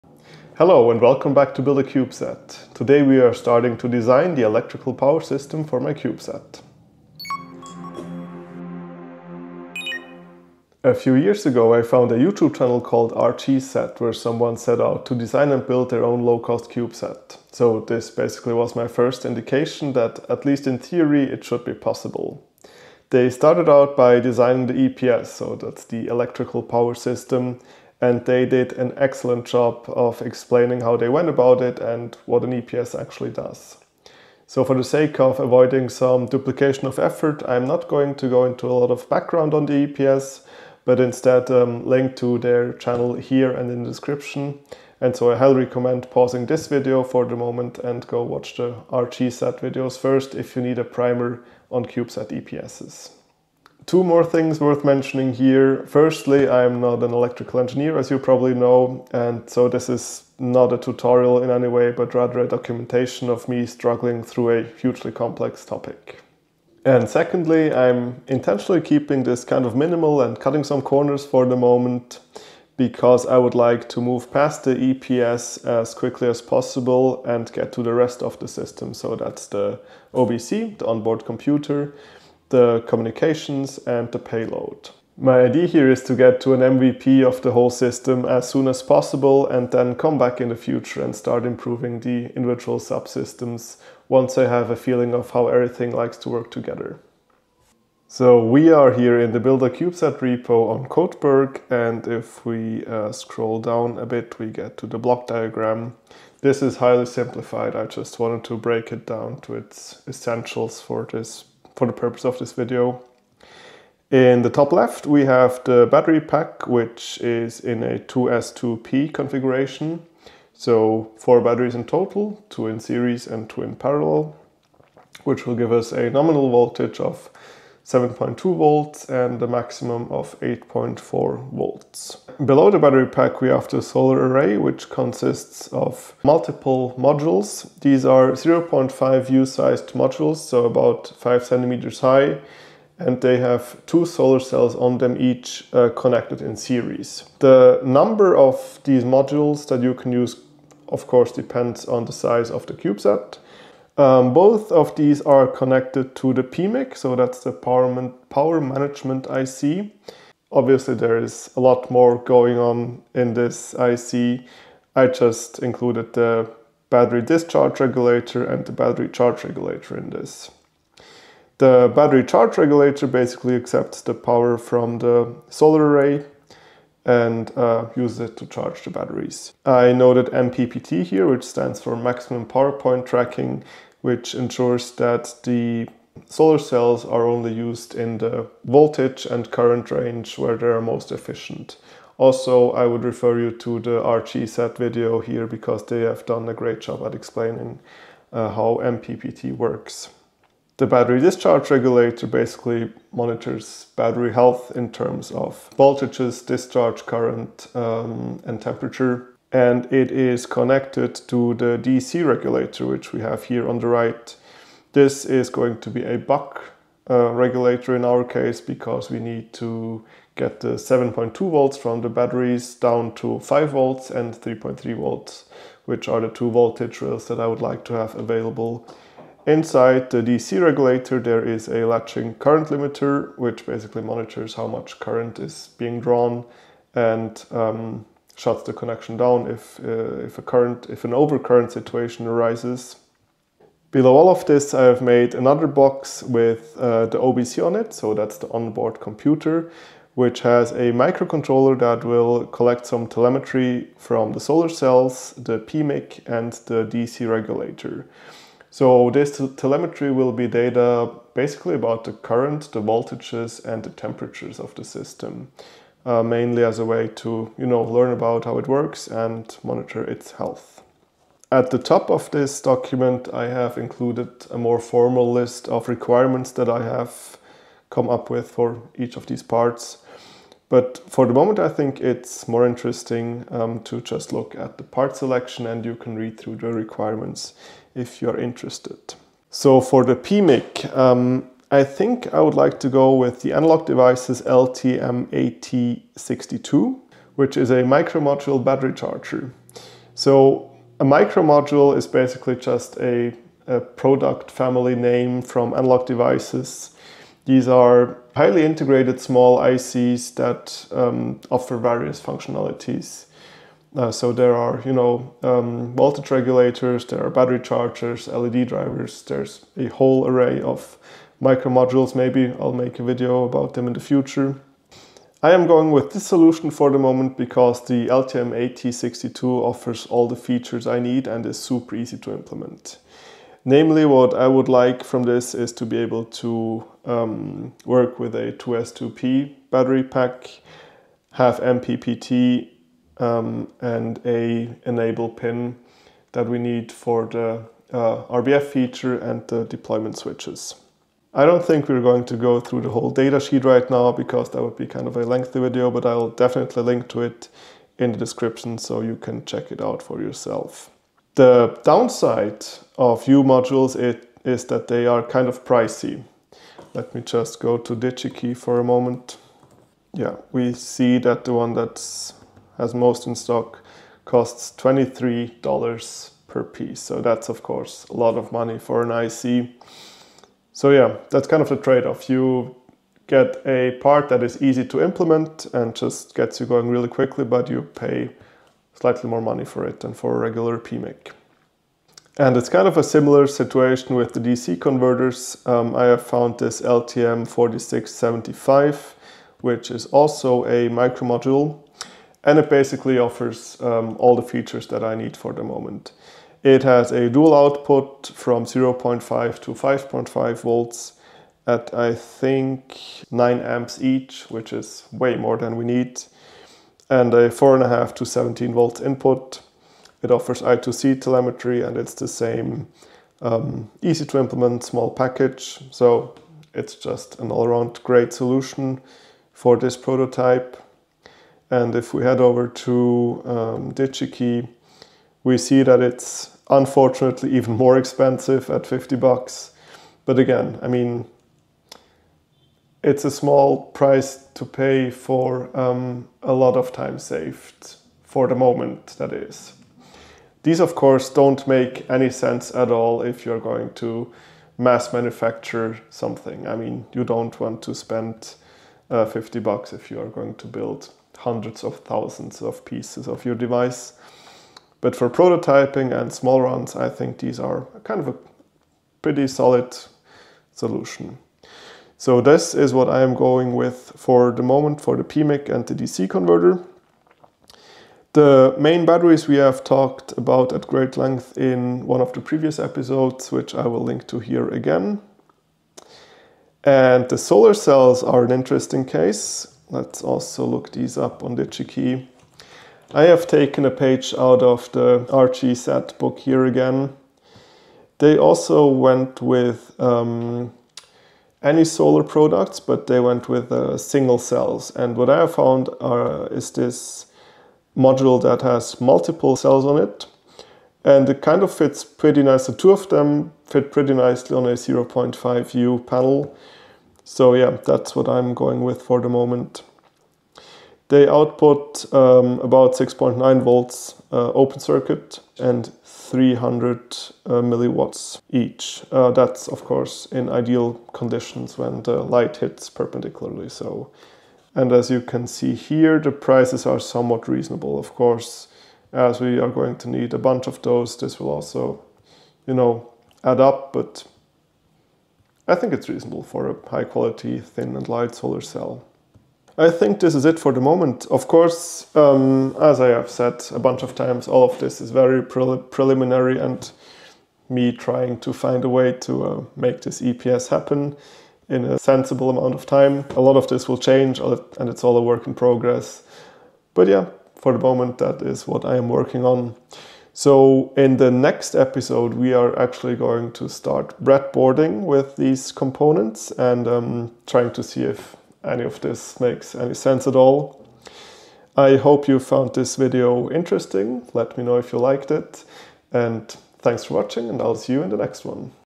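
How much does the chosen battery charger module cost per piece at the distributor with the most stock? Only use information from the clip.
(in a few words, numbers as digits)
$23.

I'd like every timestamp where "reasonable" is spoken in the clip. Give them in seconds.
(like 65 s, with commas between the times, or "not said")
537 s, 546 s.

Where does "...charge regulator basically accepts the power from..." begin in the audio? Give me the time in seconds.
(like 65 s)
172 s.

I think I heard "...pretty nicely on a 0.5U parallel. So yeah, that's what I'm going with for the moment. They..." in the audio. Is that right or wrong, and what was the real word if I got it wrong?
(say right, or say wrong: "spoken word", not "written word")
wrong: "panel", not "parallel".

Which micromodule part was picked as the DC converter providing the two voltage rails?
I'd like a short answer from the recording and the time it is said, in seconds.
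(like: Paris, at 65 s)
LTM4675, at 396 s.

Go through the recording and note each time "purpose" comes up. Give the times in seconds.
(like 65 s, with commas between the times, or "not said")
111 s.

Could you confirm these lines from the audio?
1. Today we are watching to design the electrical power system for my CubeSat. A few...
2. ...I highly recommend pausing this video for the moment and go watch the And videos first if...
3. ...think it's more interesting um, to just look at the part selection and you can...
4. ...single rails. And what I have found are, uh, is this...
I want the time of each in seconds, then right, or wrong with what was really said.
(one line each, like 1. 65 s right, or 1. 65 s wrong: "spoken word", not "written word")
1. 2 s wrong: "starting", not "watching"
2. 45 s wrong: "RGSat", not "And"
3. 281 s right
4. 503 s wrong: "cells", not "rails".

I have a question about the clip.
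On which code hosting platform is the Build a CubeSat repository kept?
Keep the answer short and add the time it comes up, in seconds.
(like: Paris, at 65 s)
Codeberg, at 100 s.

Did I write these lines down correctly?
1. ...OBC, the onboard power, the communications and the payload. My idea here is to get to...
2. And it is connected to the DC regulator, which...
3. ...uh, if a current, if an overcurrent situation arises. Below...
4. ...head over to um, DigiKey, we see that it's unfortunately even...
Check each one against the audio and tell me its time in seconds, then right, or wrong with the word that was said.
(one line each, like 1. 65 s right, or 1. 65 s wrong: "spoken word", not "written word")
1. 80 s wrong: "computer", not "power"
2. 209 s right
3. 239 s right
4. 432 s right.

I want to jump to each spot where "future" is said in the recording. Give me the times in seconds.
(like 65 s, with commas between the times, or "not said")
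90 s, 323 s.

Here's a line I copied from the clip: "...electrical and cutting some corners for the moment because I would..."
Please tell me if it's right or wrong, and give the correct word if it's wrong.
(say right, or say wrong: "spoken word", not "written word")
wrong: "minimal", not "electrical".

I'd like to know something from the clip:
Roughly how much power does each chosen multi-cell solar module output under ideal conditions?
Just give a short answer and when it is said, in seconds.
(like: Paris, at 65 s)
300 milliwatts, at 526 s.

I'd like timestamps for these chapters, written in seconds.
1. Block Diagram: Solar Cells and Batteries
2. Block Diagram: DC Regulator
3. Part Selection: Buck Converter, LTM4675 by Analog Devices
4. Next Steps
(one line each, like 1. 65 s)
1. 97 s
2. 210 s
3. 391 s
4. 549 s.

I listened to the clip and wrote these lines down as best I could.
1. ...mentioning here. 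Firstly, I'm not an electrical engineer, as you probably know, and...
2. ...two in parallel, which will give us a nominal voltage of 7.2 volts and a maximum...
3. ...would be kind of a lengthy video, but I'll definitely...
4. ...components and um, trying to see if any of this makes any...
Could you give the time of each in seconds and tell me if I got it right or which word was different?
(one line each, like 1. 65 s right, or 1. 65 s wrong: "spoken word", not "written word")
1. 54 s right
2. 123 s right
3. 354 s right
4. 575 s right.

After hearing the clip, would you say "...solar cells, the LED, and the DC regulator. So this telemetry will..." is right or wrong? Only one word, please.
wrong.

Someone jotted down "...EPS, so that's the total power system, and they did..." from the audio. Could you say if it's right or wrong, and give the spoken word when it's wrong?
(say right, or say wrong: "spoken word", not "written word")
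wrong: "electrical", not "total".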